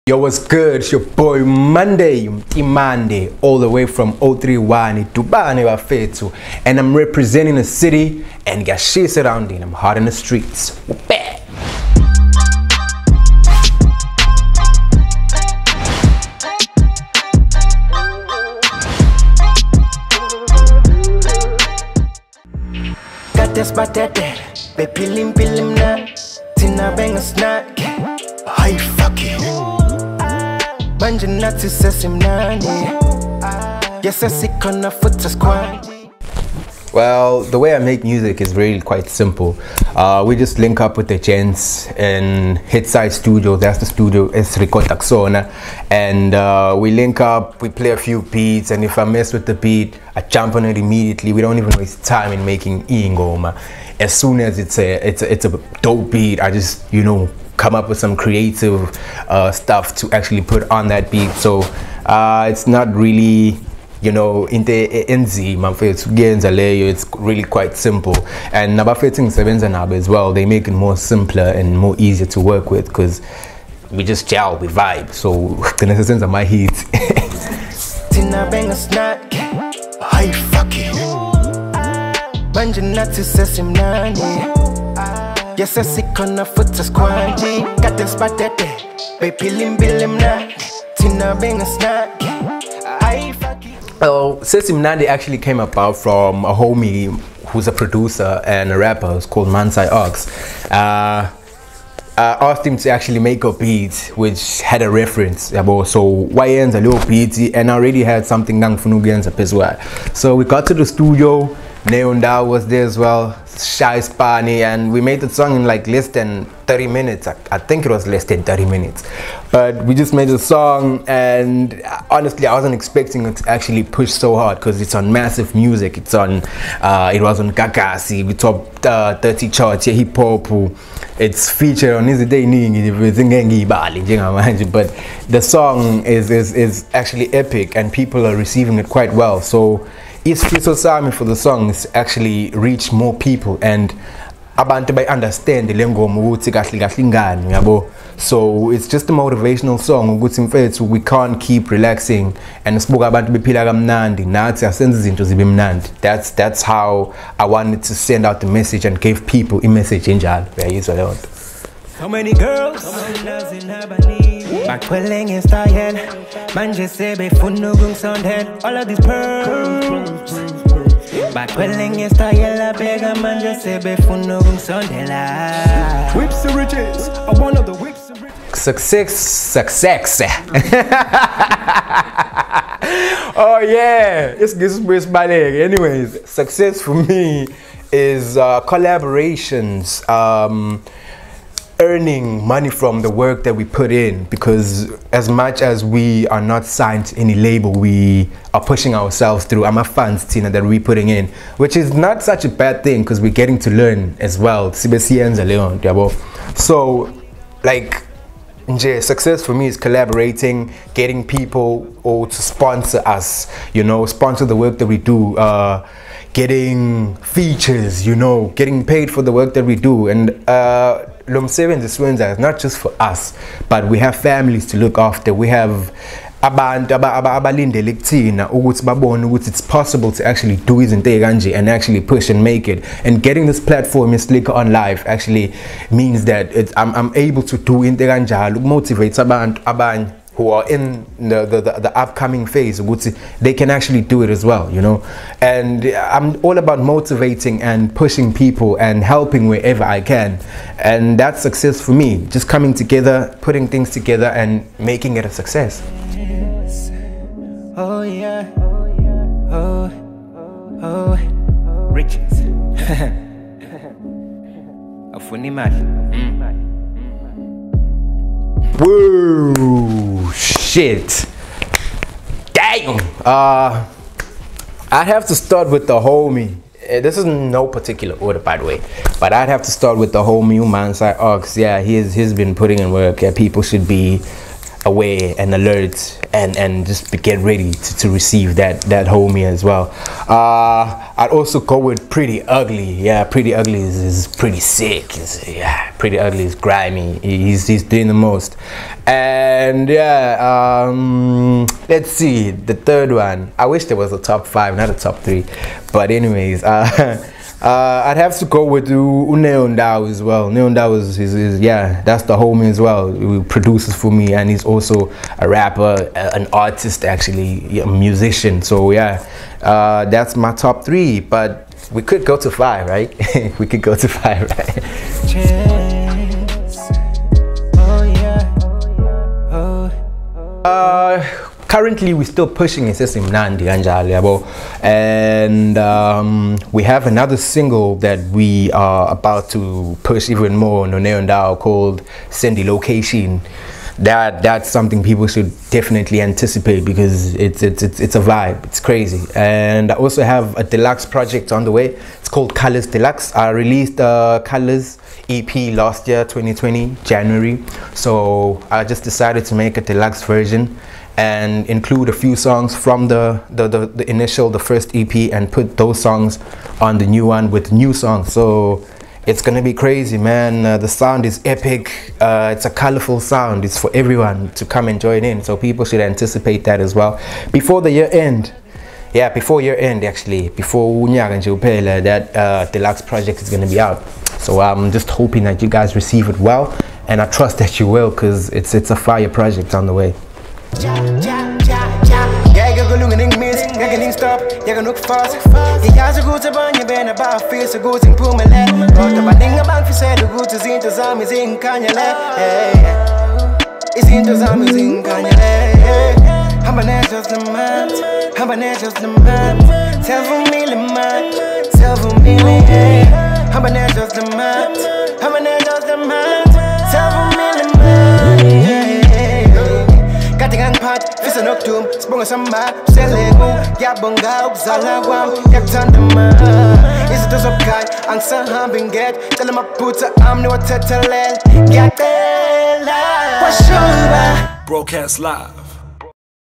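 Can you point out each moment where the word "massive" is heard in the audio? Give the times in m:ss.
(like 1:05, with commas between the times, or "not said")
2:05.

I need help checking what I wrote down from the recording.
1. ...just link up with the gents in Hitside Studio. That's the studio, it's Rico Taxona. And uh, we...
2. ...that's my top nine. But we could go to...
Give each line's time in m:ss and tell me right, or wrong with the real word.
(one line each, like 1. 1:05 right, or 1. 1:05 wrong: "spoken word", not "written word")
1. 0:40 right
2. 5:20 wrong: "three", not "nine".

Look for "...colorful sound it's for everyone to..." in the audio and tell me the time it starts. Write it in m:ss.
6:12.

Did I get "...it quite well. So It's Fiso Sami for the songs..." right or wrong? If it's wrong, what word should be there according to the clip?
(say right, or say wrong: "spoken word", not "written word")
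right.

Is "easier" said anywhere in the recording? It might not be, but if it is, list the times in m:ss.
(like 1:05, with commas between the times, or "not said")
1:11.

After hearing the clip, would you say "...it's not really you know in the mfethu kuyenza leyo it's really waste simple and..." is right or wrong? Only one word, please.
wrong.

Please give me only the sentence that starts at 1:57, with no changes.
I, I, think it was less than 30 minutes.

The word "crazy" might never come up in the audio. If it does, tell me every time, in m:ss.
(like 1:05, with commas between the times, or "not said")
5:48, 6:09.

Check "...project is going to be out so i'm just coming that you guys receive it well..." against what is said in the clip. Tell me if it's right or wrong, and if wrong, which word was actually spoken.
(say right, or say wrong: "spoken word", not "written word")
wrong: "hoping", not "coming".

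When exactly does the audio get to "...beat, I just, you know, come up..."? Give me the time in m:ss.
0:56.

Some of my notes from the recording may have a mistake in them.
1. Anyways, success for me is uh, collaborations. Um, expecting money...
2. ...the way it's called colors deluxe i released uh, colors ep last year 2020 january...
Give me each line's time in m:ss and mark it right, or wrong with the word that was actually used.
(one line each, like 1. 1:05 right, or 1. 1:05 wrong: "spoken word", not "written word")
1. 3:05 wrong: "earning", not "expecting"
2. 5:51 right.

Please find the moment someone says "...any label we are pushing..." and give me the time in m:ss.
3:17.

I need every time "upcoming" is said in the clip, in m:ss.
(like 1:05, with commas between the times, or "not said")
4:01.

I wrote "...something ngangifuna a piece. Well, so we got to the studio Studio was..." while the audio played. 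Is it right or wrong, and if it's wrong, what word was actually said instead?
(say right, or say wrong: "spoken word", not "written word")
wrong: "Neundao", not "Studio".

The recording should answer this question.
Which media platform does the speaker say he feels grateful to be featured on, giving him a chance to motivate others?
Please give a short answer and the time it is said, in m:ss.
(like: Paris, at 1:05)
Slikour OnLife, at 3:54.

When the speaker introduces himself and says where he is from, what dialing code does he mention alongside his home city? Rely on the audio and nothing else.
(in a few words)
031.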